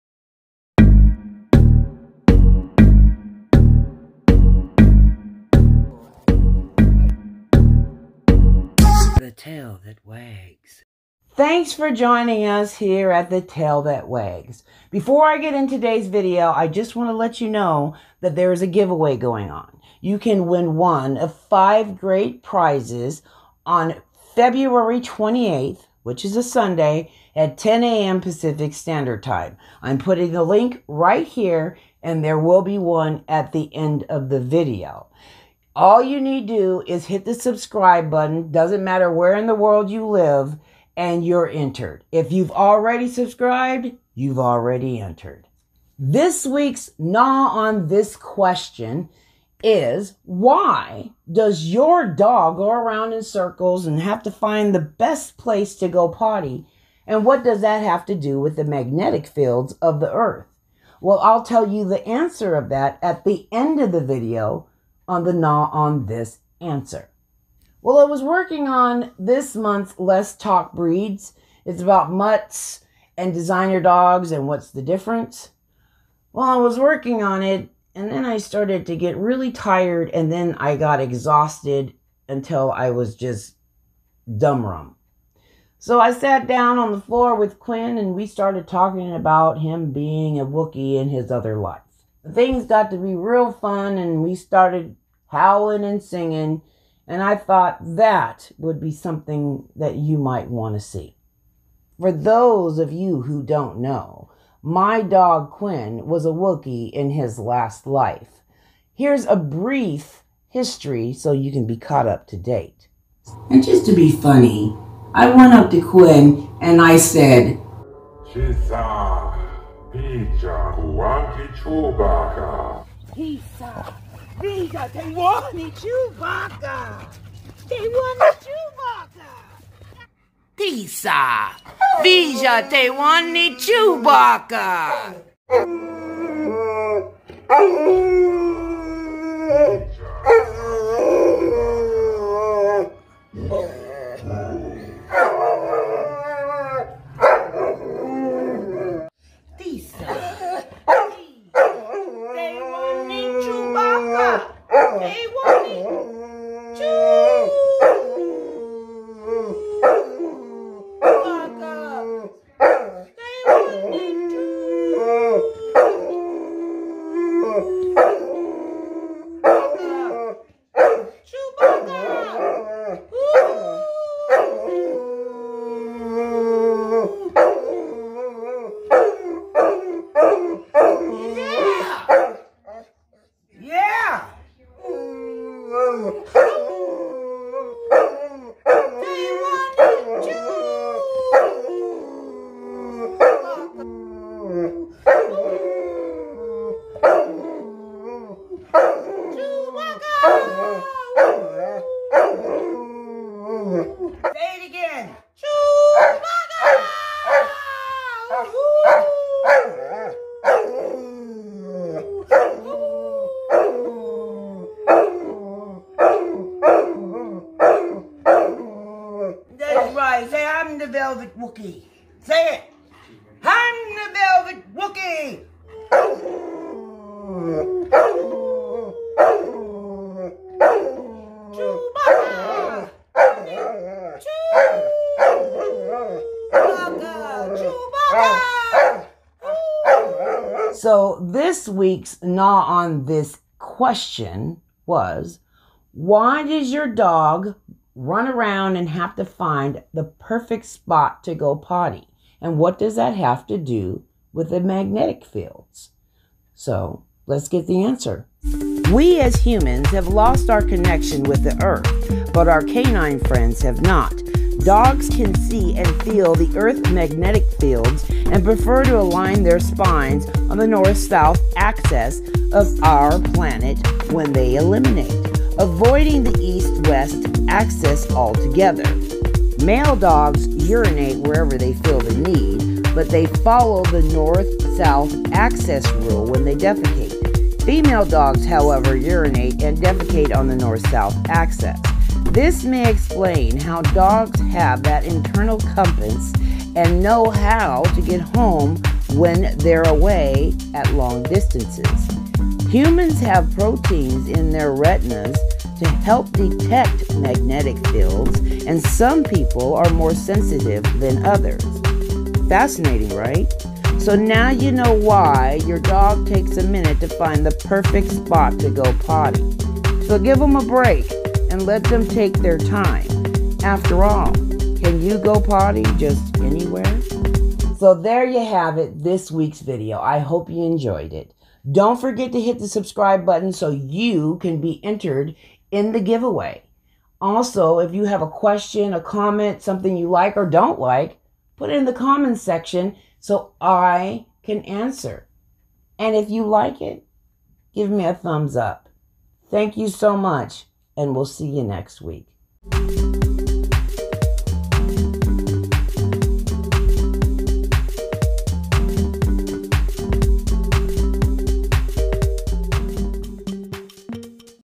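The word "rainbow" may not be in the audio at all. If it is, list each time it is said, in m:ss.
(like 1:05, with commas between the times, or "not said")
not said.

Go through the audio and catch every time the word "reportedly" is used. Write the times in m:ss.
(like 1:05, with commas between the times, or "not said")
not said.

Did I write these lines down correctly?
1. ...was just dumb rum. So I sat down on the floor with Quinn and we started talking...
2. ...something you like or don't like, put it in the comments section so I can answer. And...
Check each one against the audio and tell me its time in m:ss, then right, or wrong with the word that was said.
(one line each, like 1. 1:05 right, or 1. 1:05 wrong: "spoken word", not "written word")
1. 1:22 right
2. 5:39 right.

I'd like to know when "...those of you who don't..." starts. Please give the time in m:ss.
1:42.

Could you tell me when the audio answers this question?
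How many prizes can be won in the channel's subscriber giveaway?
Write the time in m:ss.
0:21.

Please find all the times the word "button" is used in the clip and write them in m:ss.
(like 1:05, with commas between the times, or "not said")
0:38, 5:33.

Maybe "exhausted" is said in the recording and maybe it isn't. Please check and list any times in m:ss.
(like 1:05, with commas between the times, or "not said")
1:21.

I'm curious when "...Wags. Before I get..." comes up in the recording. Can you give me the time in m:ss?
0:14.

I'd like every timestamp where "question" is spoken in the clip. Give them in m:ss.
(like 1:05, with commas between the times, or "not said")
0:48, 4:03, 5:38.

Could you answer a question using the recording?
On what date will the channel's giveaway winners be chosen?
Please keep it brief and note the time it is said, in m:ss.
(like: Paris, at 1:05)
February 28th, at 0:24.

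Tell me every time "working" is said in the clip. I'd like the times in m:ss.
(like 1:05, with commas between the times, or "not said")
1:08, 1:16.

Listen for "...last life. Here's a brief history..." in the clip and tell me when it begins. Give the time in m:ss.
1:47.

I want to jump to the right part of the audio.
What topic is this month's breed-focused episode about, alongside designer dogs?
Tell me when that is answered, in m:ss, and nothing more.
1:12.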